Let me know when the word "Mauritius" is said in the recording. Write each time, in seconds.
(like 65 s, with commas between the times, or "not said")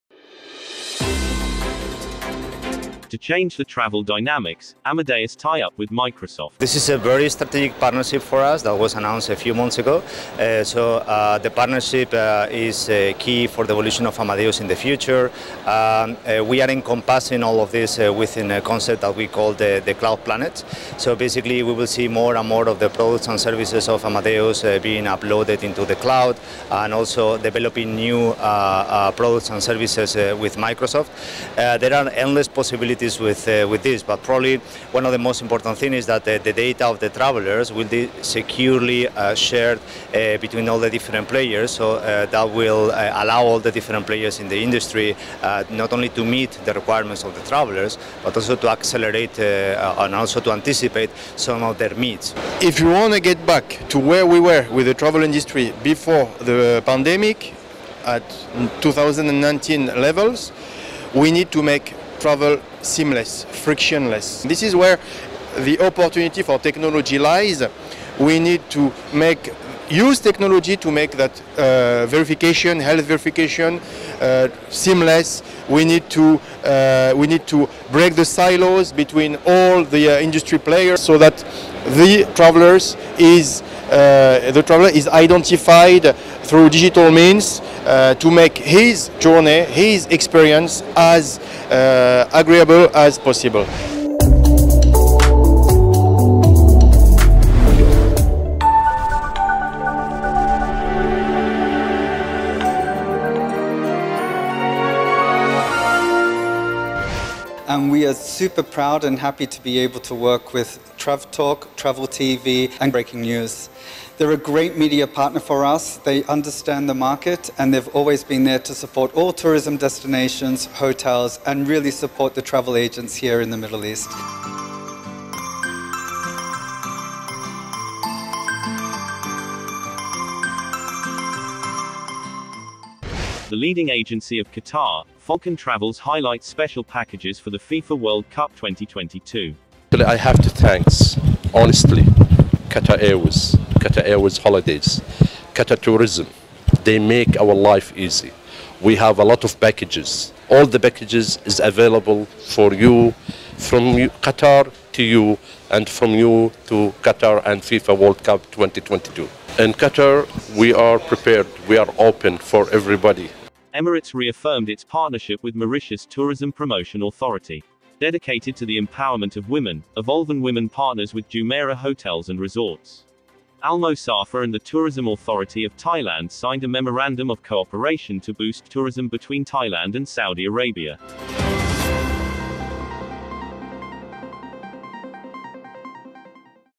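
165 s.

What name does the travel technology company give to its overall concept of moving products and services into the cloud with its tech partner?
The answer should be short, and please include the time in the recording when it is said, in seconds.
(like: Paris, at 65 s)
The cloud planet, at 19 s.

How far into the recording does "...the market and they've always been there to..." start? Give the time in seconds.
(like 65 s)
116 s.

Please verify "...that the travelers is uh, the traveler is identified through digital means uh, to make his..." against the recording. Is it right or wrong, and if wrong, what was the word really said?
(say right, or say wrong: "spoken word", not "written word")
right.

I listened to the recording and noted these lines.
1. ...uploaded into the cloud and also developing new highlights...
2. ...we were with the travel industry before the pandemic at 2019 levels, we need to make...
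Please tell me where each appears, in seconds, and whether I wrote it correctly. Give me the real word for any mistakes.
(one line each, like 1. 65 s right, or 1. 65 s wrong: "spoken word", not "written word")
1. 25 s wrong: "products", not "highlights"
2. 54 s right.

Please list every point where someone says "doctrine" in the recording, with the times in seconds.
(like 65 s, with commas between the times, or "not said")
not said.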